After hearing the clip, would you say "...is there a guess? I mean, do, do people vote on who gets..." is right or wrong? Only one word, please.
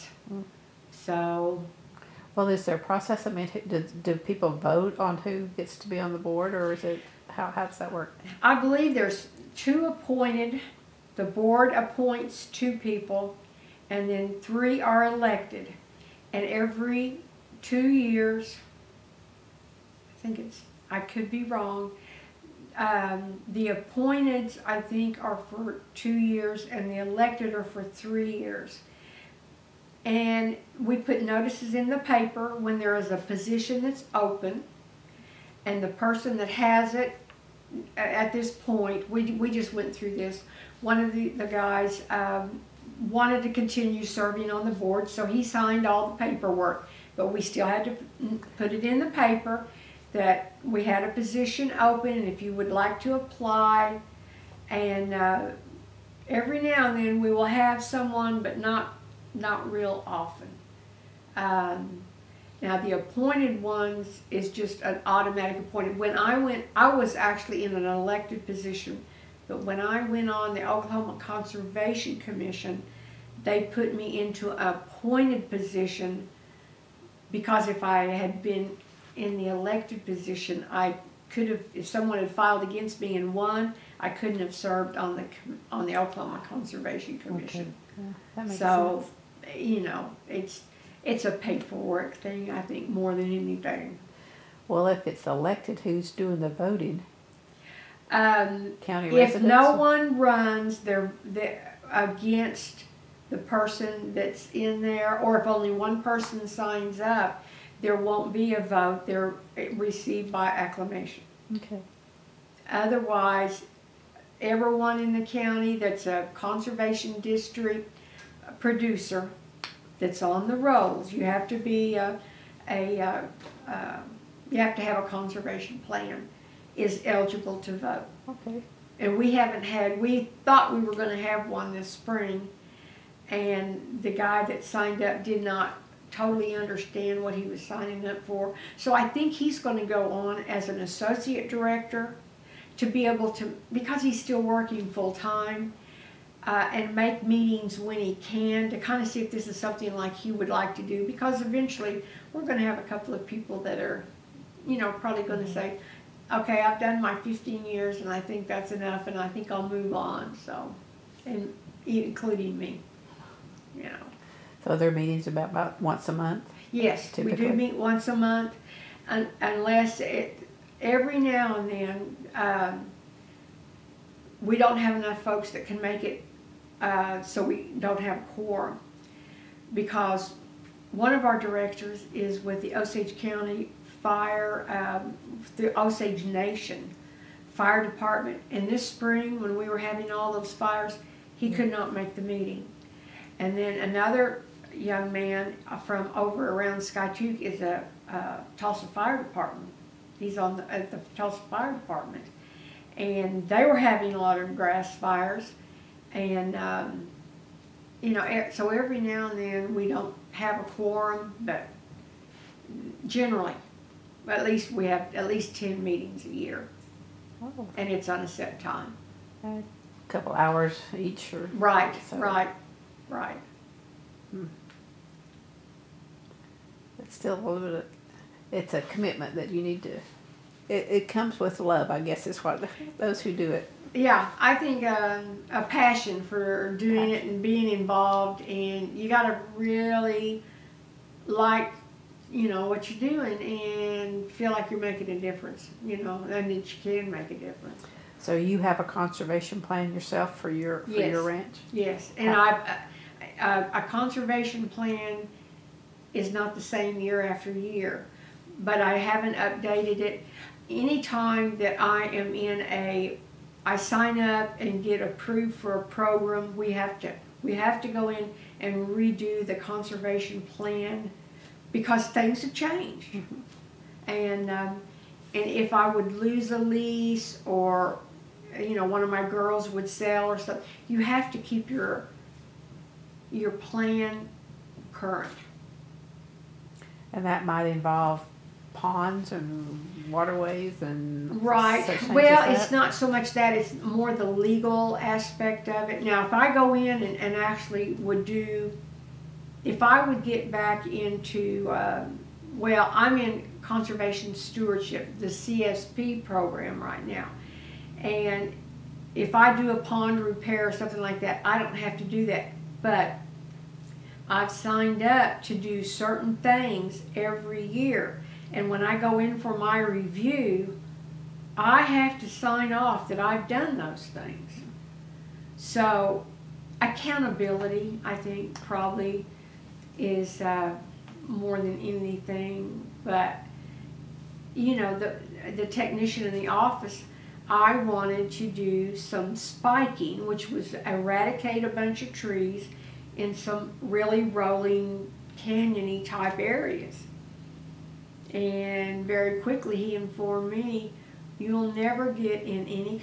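wrong.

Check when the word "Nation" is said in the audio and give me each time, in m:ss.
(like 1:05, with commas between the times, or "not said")
3:06.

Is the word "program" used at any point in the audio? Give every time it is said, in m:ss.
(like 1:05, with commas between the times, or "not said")
4:25, 5:06.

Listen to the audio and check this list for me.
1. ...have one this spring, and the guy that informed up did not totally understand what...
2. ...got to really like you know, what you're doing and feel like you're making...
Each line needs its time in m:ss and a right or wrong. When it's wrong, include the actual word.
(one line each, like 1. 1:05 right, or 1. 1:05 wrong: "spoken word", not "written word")
1. 2:11 wrong: "signed", not "informed"
2. 3:59 right.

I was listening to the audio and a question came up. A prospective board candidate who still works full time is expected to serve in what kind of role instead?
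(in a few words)
Associate director.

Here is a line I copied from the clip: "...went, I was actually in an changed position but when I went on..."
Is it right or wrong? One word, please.
wrong.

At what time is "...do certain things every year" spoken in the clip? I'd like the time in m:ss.
5:15.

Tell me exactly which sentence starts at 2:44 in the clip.
So their meetings about, about once a month?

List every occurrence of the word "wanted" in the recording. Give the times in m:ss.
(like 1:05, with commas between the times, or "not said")
0:43, 5:37.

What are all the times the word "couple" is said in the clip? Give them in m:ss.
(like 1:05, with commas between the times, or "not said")
2:32, 3:40.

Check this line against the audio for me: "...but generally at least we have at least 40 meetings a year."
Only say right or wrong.
wrong.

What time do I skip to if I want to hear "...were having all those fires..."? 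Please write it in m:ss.
3:09.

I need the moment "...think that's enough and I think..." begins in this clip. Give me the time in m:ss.
2:38.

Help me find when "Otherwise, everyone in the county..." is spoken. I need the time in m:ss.
1:52.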